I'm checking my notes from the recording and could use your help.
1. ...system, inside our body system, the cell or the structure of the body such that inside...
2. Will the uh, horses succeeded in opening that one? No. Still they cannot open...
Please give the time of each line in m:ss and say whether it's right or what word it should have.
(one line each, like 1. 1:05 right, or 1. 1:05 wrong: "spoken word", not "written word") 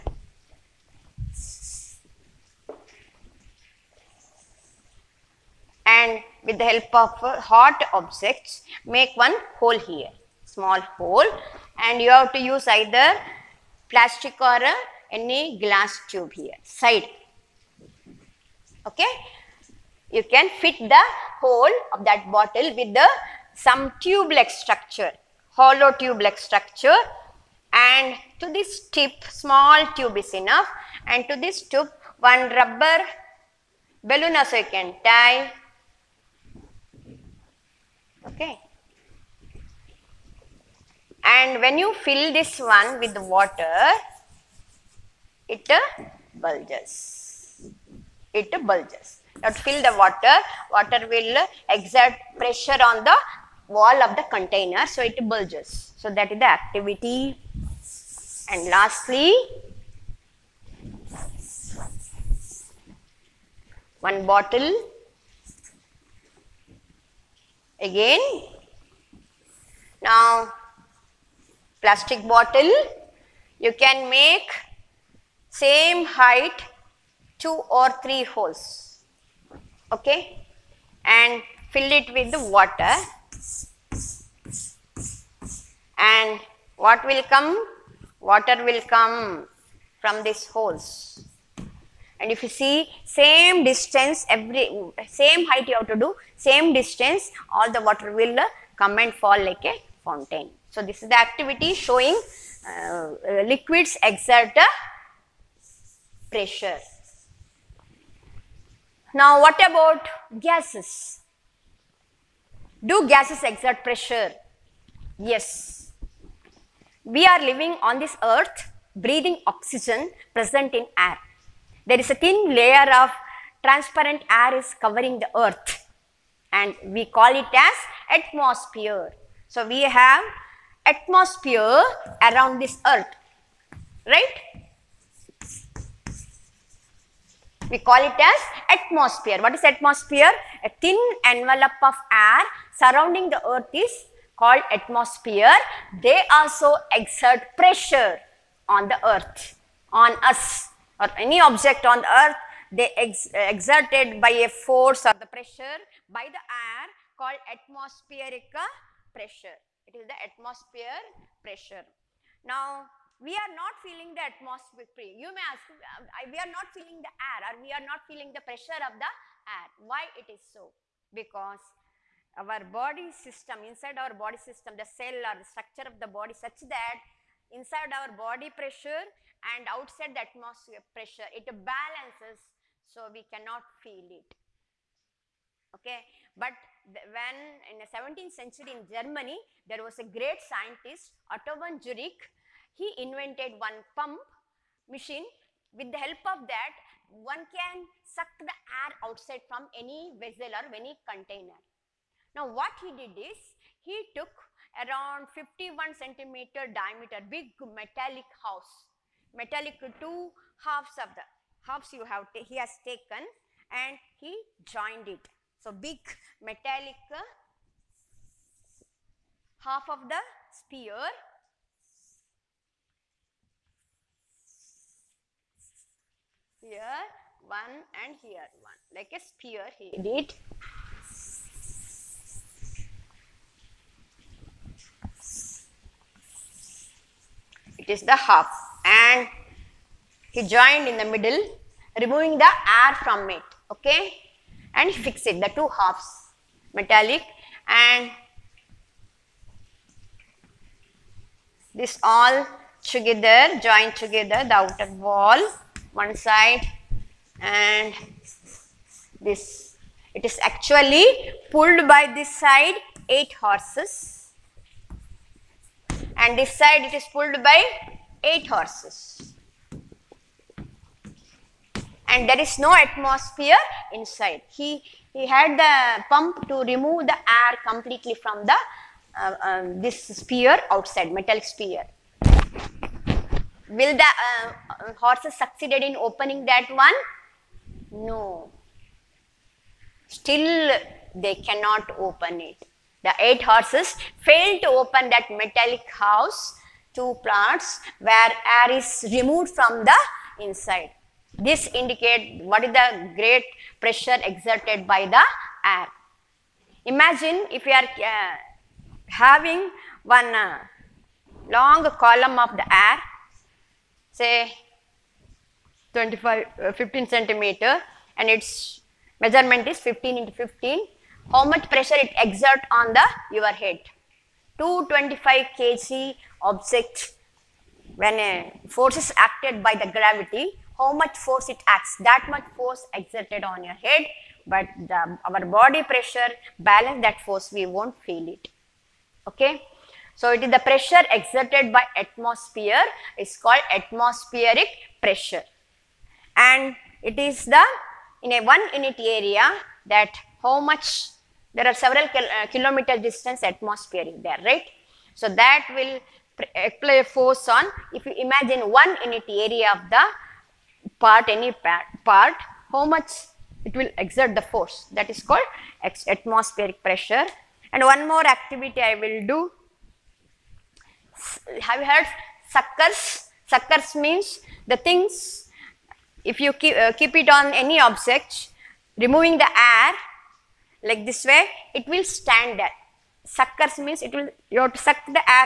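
1. 2:53 right
2. 4:43 right.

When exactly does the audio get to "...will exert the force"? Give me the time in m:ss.
6:03.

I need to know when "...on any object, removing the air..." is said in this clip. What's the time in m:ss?
6:17.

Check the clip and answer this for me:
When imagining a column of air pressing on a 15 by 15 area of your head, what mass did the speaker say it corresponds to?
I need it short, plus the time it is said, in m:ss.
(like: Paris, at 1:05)
225 kg, at 5:24.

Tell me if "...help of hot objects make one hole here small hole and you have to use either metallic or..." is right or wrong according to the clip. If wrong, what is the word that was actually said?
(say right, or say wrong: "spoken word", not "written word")
wrong: "plastic", not "metallic".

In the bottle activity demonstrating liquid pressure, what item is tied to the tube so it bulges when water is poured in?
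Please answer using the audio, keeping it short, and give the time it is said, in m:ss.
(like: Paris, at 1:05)
rubber balloon, at 0:32.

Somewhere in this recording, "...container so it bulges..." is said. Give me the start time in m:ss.
0:54.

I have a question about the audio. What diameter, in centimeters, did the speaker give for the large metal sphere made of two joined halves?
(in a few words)
51 centimeters.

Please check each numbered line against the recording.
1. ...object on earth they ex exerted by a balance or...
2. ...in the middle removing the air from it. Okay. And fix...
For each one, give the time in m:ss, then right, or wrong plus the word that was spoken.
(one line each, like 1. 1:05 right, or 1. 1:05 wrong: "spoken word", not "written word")
1. 2:31 wrong: "force", not "balance"
2. 4:00 right.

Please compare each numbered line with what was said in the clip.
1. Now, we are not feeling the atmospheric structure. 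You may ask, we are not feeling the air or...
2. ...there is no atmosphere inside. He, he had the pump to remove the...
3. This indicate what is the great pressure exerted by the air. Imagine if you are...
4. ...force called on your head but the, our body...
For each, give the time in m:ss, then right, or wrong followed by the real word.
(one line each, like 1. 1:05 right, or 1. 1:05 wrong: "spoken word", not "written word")
1. 2:42 wrong: "pressure", not "structure"
2. 4:32 right
3. 5:01 right
4. 5:32 wrong: "exerted", not "called".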